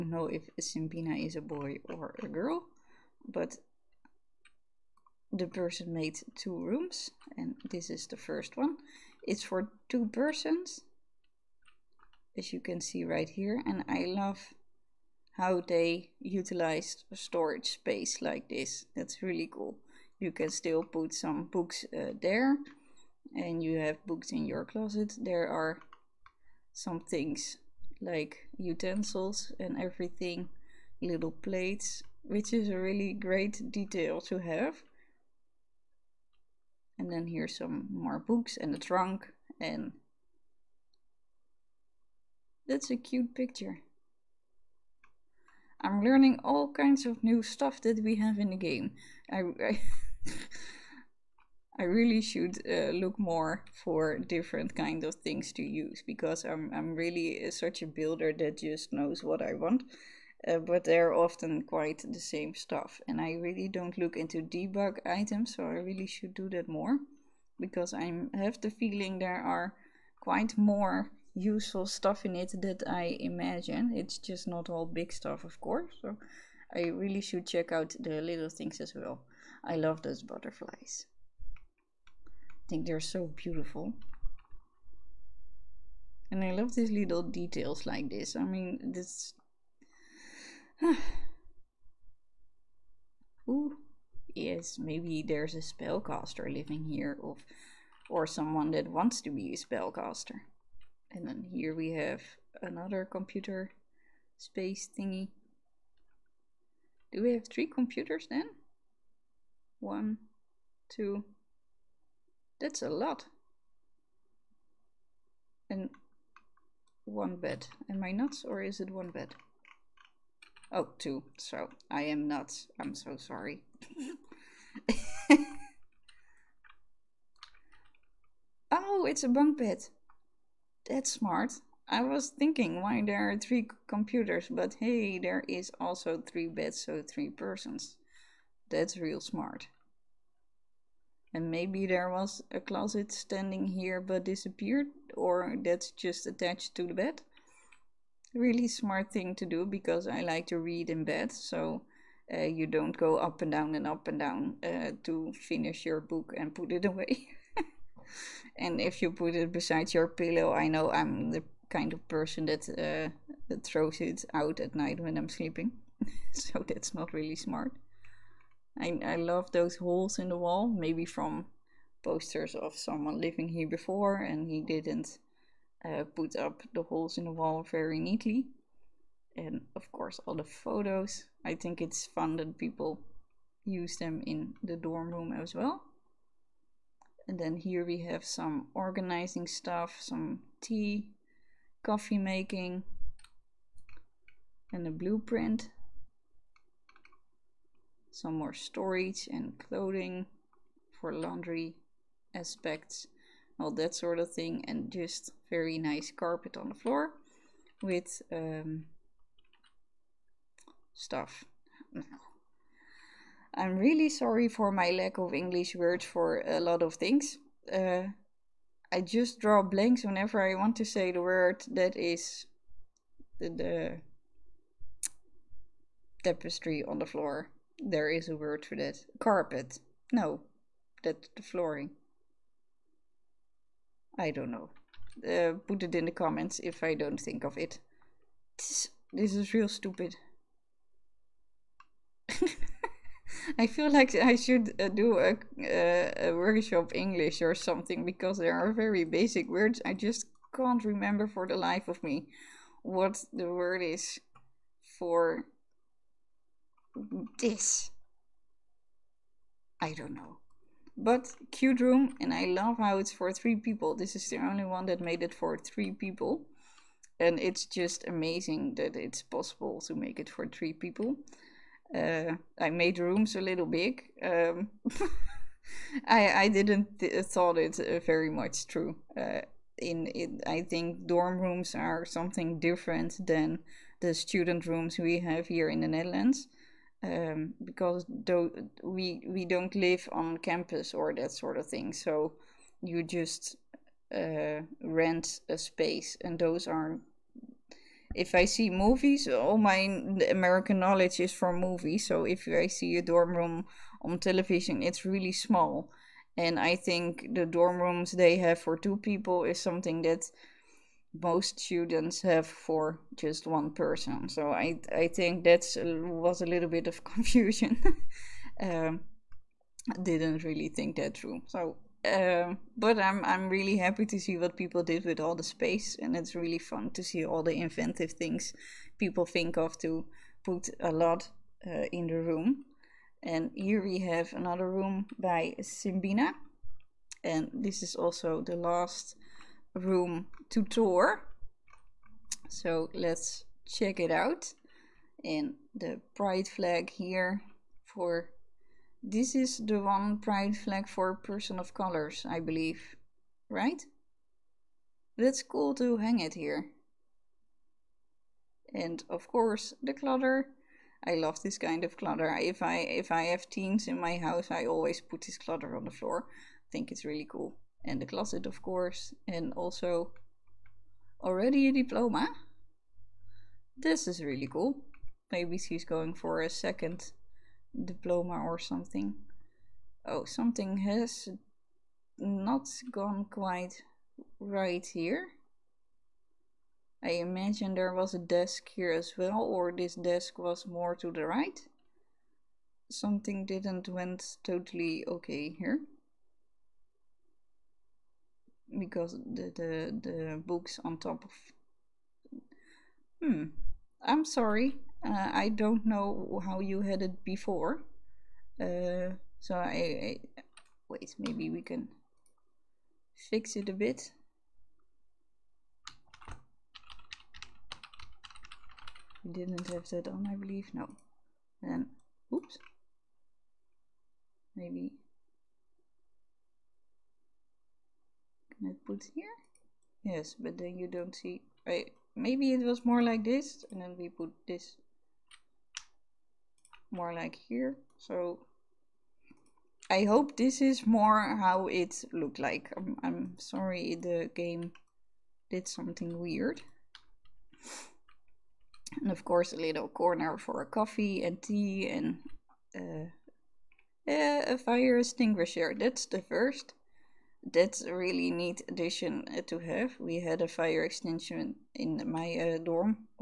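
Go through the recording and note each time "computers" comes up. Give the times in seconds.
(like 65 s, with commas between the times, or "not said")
103 s, 107 s, 133 s.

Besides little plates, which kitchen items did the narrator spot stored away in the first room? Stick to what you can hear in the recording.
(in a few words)
Utensils.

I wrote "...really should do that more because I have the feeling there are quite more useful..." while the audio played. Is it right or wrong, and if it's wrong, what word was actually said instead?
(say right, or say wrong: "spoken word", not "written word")
right.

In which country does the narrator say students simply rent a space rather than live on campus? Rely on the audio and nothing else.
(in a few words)
The Netherlands.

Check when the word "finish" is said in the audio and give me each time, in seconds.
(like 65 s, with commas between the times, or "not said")
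155 s.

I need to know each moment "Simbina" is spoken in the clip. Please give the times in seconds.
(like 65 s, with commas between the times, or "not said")
0 s, 335 s.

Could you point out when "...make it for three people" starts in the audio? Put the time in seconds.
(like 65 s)
269 s.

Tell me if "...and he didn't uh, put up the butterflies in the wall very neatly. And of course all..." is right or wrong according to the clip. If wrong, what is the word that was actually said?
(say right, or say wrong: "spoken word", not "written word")
wrong: "holes", not "butterflies".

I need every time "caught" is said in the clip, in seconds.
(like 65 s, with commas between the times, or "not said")
not said.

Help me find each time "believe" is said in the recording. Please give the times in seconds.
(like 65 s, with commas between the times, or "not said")
352 s, 420 s.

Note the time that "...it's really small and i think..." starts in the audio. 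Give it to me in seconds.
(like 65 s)
304 s.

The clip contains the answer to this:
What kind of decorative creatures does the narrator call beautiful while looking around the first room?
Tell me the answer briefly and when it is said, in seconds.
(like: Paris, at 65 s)
Butterflies, at 80 s.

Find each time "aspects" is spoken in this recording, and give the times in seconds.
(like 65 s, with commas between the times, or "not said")
202 s.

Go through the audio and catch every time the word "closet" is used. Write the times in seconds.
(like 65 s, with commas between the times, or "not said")
24 s, 142 s, 368 s.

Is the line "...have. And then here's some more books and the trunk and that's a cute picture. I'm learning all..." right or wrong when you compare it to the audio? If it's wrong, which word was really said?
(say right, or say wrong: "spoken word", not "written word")
right.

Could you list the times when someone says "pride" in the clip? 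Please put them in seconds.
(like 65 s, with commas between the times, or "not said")
346 s, 350 s.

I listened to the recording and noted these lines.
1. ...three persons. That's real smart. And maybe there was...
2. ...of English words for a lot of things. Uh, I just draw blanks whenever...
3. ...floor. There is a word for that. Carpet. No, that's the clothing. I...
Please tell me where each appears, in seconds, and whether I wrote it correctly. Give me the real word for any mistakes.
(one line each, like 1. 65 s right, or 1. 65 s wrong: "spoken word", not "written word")
1. 137 s right
2. 215 s right
3. 227 s wrong: "flooring", not "clothing".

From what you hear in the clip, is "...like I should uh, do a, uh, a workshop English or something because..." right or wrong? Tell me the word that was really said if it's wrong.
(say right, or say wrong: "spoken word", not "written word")
right.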